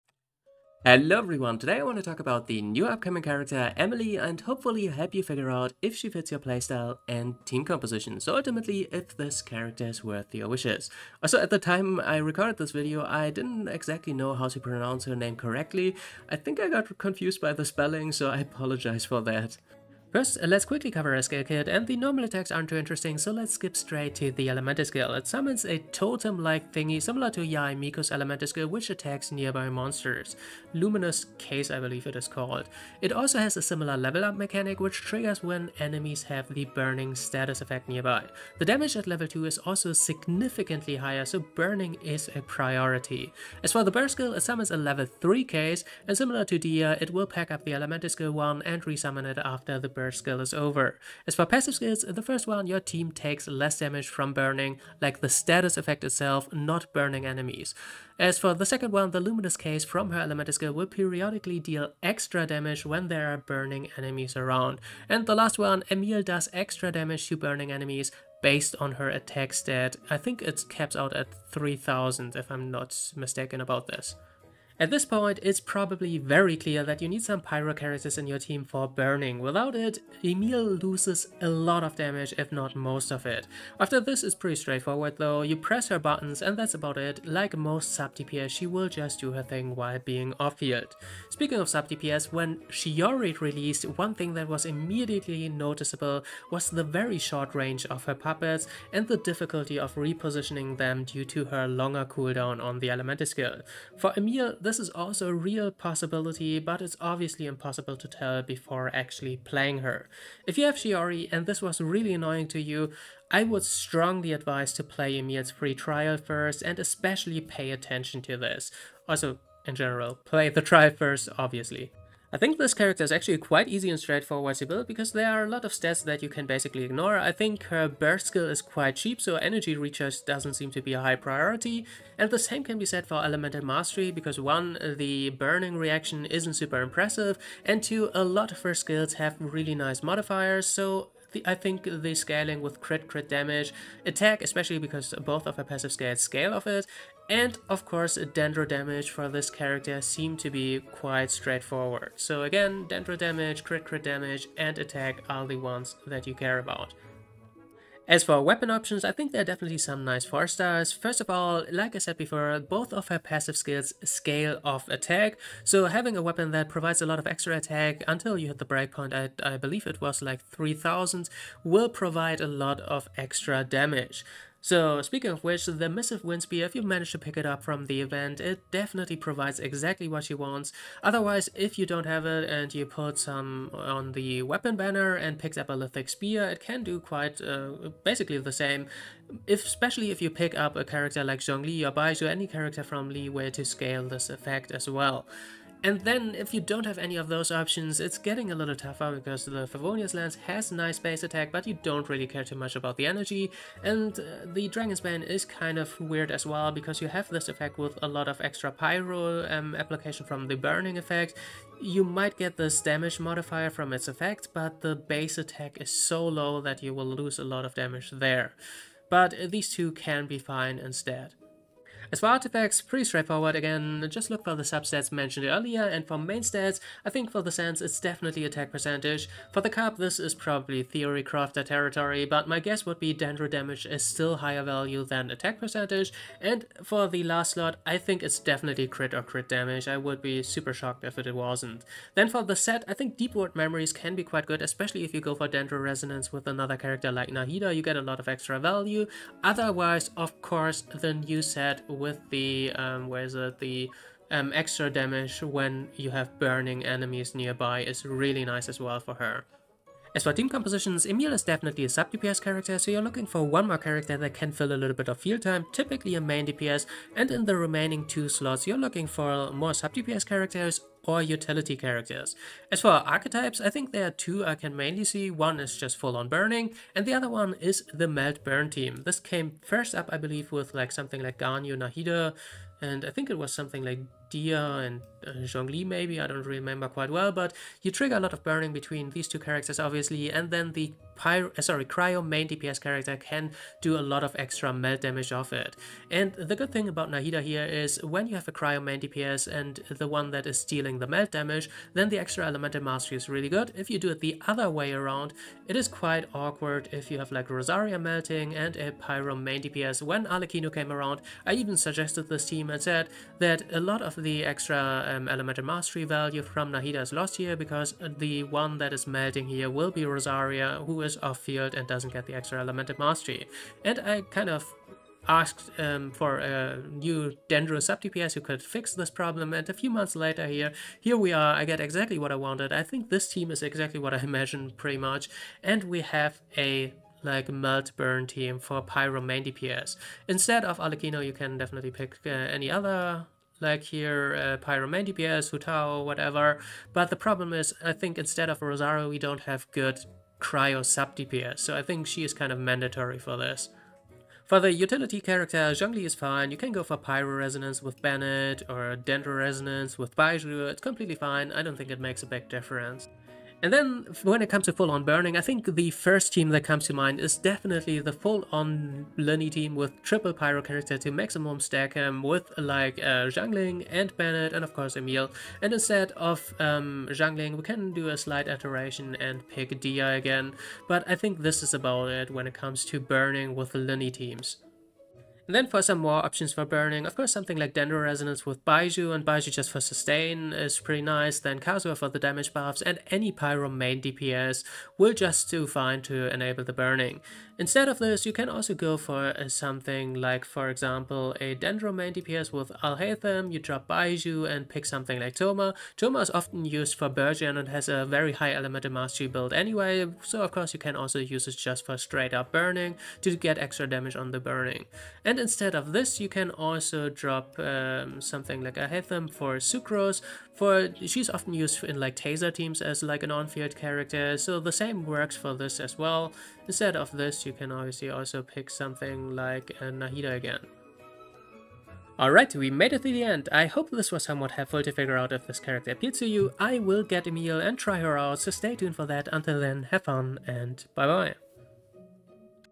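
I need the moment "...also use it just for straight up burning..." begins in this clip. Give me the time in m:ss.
6:50.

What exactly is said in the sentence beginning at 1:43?
For Emil, this this is also a real possibility, but it's obviously impossible to tell before actually playing her.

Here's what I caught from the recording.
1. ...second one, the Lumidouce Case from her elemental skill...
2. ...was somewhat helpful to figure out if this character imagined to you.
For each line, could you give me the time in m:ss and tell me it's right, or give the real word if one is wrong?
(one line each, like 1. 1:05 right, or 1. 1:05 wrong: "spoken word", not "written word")
1. 0:58 right
2. 7:14 wrong: "appealed", not "imagined".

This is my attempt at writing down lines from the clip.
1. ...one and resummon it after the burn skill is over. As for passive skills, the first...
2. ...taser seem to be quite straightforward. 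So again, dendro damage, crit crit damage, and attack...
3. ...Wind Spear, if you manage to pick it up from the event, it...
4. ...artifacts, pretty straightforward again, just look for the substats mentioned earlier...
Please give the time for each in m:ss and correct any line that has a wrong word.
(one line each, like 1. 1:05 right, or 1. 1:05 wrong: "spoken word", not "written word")
1. 0:48 right
2. 2:29 wrong: "character", not "taser"
3. 2:56 right
4. 3:42 right.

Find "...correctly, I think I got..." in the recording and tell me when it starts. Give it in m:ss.
0:15.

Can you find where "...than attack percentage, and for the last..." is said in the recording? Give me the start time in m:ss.
3:55.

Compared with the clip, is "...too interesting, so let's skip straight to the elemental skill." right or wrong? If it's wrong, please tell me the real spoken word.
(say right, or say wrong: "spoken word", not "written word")
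right.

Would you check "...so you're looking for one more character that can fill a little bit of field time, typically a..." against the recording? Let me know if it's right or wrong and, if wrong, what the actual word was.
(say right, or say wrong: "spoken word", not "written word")
right.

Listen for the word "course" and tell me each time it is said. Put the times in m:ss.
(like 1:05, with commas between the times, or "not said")
2:27, 4:10, 6:14, 6:27, 6:50.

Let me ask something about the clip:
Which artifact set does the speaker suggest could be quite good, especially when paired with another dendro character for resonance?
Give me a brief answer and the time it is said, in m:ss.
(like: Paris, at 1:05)
Deepwood Memories, at 4:03.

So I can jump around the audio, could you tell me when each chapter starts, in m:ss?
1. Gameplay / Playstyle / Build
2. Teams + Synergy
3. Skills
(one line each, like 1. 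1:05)
1. 1:14
2. 4:20
3. 0:20.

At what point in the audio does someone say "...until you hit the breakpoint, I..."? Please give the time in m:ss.
2:48.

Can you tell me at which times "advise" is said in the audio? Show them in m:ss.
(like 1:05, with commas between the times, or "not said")
1:54.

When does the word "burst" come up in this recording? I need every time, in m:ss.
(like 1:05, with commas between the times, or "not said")
0:43, 2:07.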